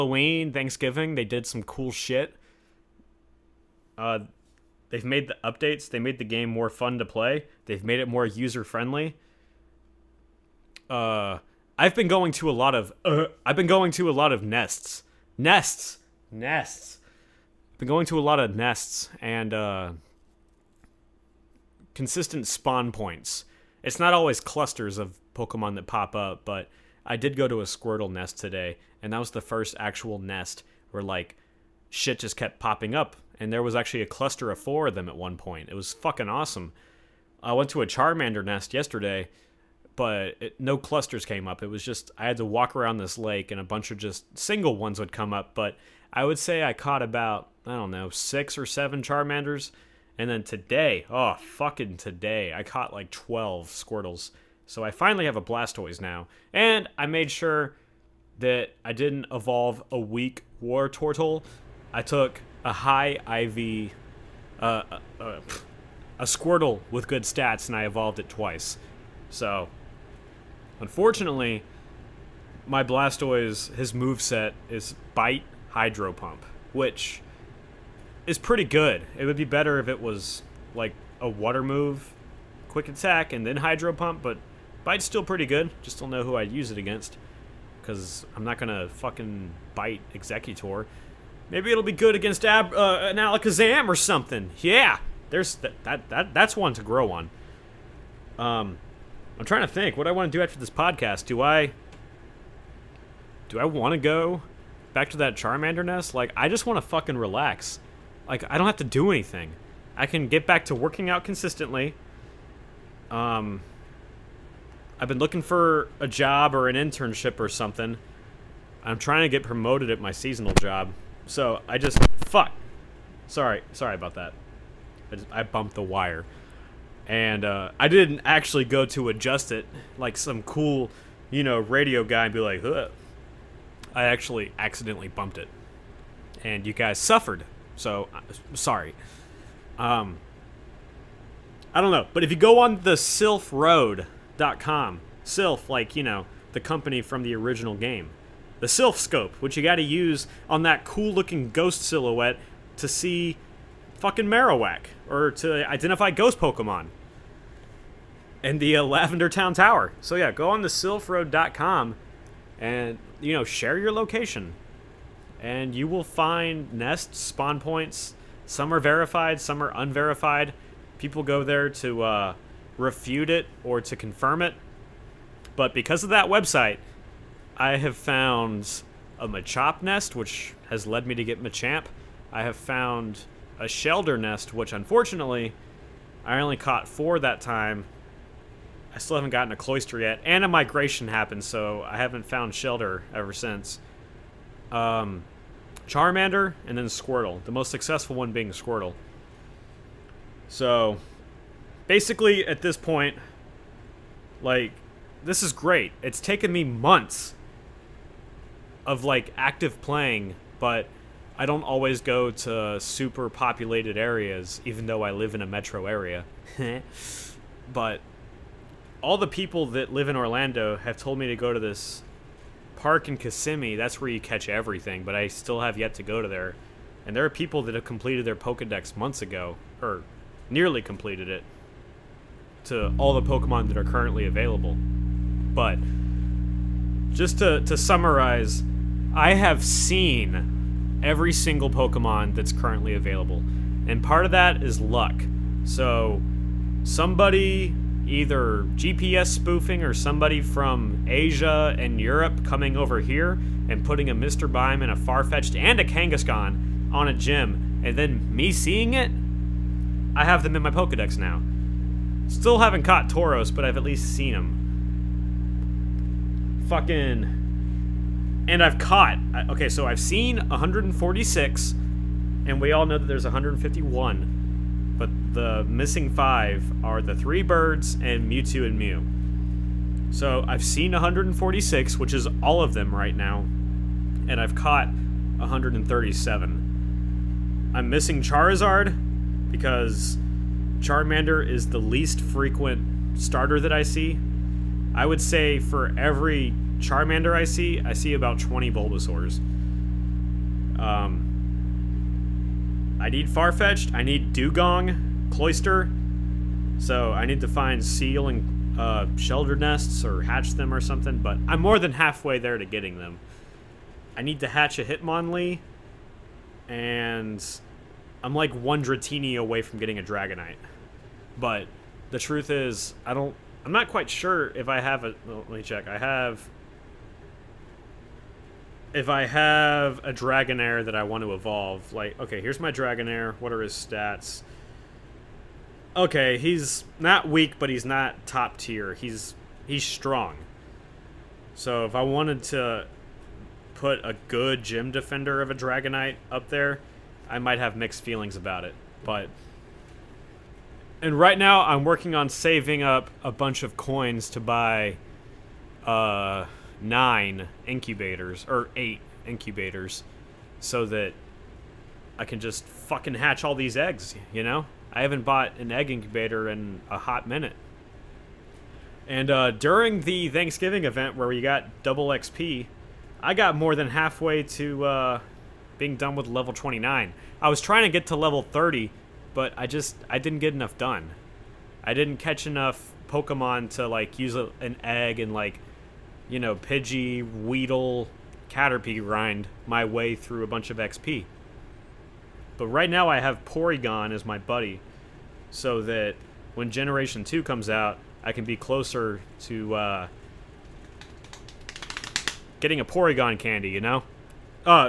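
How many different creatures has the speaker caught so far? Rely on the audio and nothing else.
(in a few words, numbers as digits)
137.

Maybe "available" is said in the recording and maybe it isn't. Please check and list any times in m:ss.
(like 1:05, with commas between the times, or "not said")
3:54, 4:02.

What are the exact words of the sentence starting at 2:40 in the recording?
So yeah, go on the silphroad.com and you know share your location and you will find nests, spawn points.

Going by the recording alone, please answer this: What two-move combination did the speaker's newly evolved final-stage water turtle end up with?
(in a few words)
Bite Hydro Pump.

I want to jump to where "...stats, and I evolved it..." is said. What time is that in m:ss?
1:07.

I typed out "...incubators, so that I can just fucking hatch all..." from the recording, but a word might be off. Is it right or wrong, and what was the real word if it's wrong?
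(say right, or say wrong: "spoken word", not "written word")
right.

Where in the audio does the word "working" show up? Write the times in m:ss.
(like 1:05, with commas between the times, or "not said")
1:50, 5:51.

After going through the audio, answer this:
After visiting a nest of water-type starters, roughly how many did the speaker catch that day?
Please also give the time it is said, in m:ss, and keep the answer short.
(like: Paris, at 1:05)
12, at 0:53.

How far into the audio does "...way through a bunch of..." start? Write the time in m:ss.
6:29.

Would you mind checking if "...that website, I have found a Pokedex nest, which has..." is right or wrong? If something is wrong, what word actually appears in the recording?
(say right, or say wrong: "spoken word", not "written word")
wrong: "Machop", not "Pokedex".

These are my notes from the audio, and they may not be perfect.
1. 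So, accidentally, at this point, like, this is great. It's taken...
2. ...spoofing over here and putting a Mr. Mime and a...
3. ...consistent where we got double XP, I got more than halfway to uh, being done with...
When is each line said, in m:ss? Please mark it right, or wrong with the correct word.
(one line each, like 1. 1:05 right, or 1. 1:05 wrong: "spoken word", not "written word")
1. 3:20 wrong: "basically", not "accidentally"
2. 4:12 wrong: "coming", not "spoofing"
3. 6:10 wrong: "event", not "consistent".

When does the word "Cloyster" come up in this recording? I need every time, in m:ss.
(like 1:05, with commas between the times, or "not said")
3:09, 5:05.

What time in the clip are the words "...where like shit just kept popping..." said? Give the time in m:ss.
0:30.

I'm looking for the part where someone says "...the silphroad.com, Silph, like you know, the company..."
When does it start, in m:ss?
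2:22.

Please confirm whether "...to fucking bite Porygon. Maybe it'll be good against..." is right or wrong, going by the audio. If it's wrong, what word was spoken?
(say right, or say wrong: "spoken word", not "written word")
wrong: "Exeggutor", not "Porygon".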